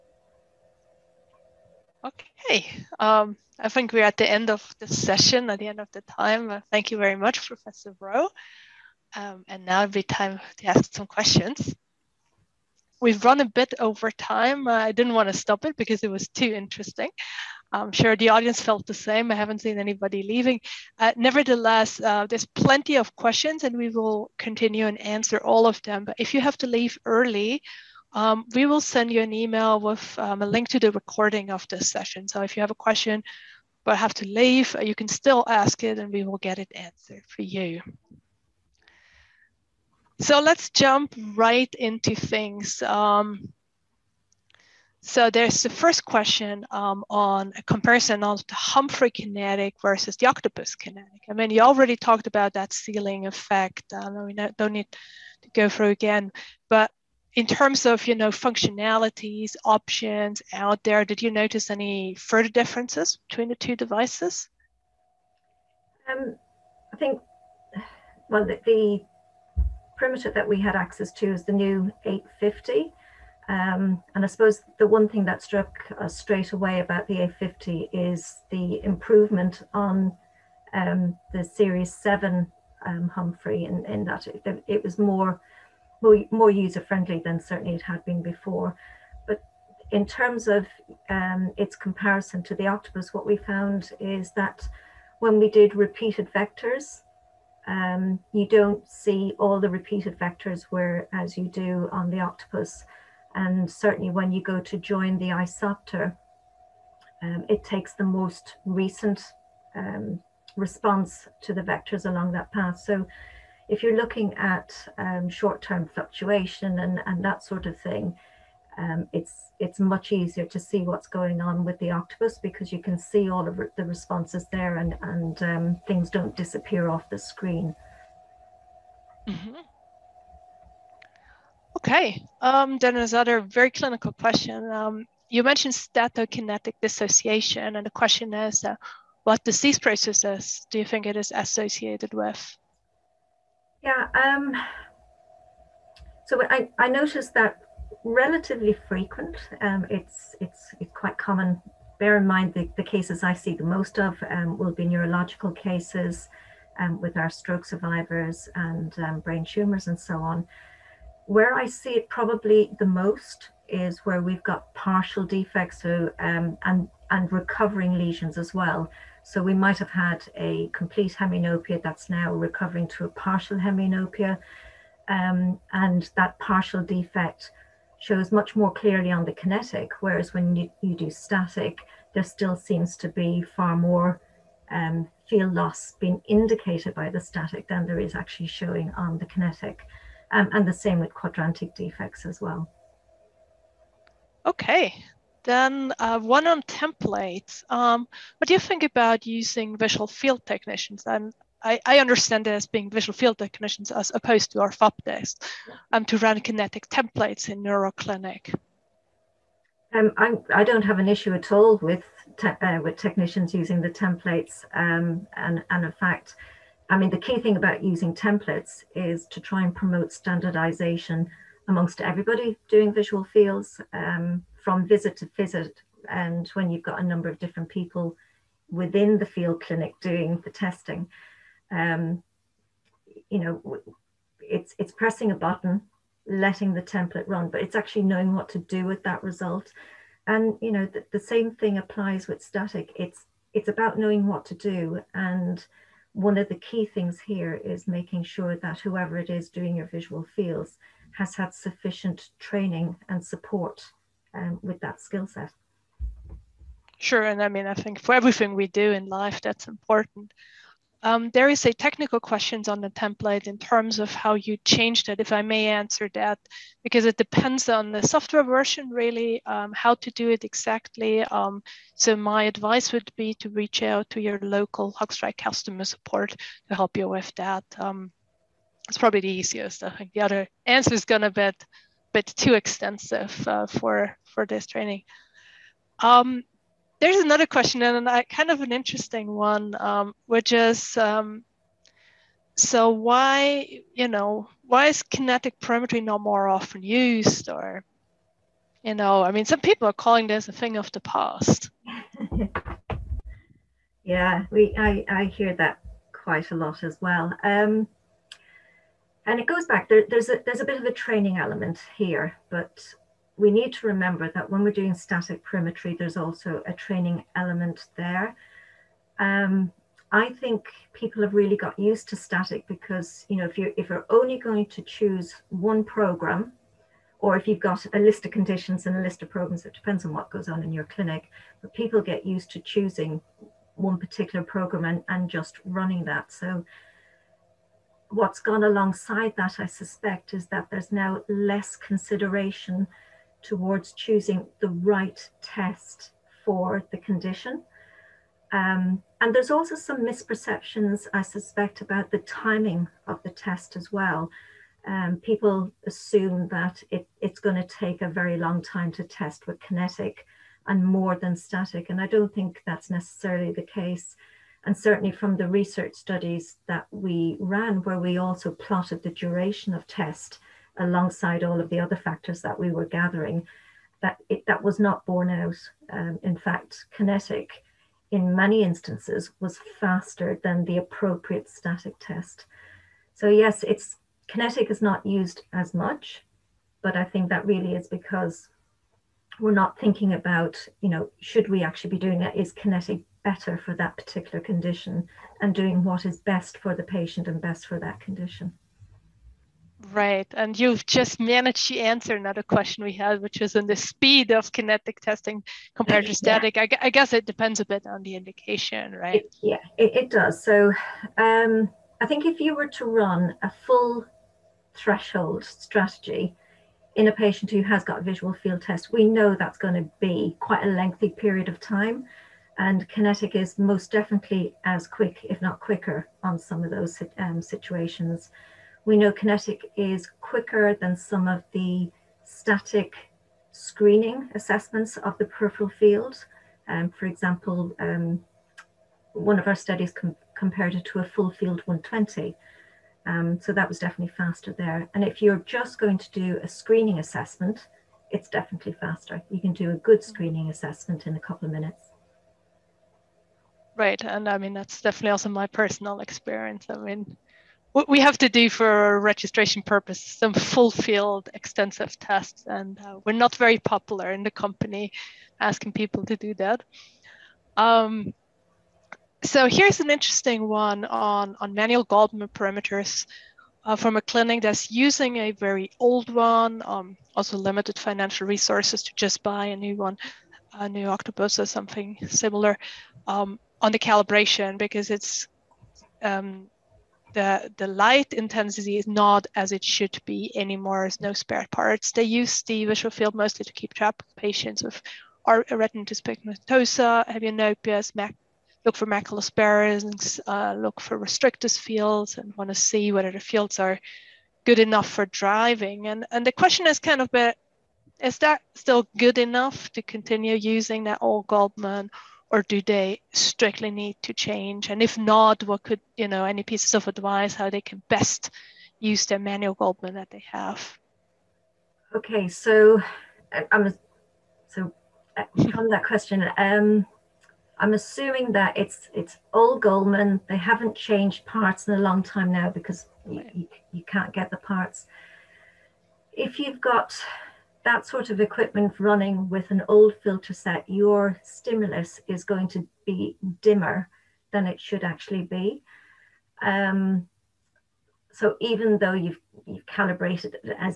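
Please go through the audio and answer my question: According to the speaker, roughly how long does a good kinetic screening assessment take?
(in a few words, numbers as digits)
a couple of minutes.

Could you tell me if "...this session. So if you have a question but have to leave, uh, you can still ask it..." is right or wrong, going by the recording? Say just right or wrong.
right.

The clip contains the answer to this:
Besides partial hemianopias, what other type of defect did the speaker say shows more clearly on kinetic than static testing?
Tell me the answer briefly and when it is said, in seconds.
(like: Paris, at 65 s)
quadrantic defects, at 191 s.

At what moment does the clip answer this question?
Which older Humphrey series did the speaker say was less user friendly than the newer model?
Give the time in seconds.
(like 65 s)
81 s.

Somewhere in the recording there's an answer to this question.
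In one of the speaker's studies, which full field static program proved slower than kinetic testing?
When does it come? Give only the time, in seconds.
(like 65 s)
441 s.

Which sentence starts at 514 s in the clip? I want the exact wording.
And if not, what could, you know, any pieces of advice how they can best use their manual Goldmann that they have?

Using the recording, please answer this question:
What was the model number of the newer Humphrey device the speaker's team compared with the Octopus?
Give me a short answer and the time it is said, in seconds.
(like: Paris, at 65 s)
850, at 71 s.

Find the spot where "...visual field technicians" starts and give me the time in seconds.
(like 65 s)
199 s.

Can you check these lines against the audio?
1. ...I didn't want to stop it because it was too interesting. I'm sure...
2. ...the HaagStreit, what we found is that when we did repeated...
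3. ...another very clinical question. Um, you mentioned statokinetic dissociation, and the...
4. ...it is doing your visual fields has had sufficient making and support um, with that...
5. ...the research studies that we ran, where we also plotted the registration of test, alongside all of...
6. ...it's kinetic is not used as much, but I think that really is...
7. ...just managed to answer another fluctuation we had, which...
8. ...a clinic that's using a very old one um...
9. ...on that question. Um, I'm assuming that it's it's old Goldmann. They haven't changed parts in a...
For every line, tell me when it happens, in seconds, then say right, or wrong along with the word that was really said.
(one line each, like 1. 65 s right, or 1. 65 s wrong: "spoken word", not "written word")
1. 14 s right
2. 92 s wrong: "Octopus", not "HaagStreit"
3. 133 s right
4. 249 s wrong: "training", not "making"
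5. 365 s wrong: "duration", not "registration"
6. 383 s right
7. 400 s wrong: "question", not "fluctuation"
8. 473 s right
9. 525 s right.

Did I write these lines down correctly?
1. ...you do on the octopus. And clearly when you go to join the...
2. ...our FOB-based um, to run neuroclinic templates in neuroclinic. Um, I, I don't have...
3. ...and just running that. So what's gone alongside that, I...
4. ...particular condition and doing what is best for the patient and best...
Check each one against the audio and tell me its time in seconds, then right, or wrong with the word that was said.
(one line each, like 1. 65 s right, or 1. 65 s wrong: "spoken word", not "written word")
1. 101 s wrong: "certainly", not "clearly"
2. 204 s wrong: "kinetic", not "neuroclinic"
3. 335 s right
4. 393 s right.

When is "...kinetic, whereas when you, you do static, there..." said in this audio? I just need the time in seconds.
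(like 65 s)
179 s.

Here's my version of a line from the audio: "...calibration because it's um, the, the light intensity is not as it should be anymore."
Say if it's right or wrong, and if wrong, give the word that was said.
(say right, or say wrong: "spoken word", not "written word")
right.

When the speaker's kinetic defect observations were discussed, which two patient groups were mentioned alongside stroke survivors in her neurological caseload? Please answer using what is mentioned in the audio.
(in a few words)
brain tumors.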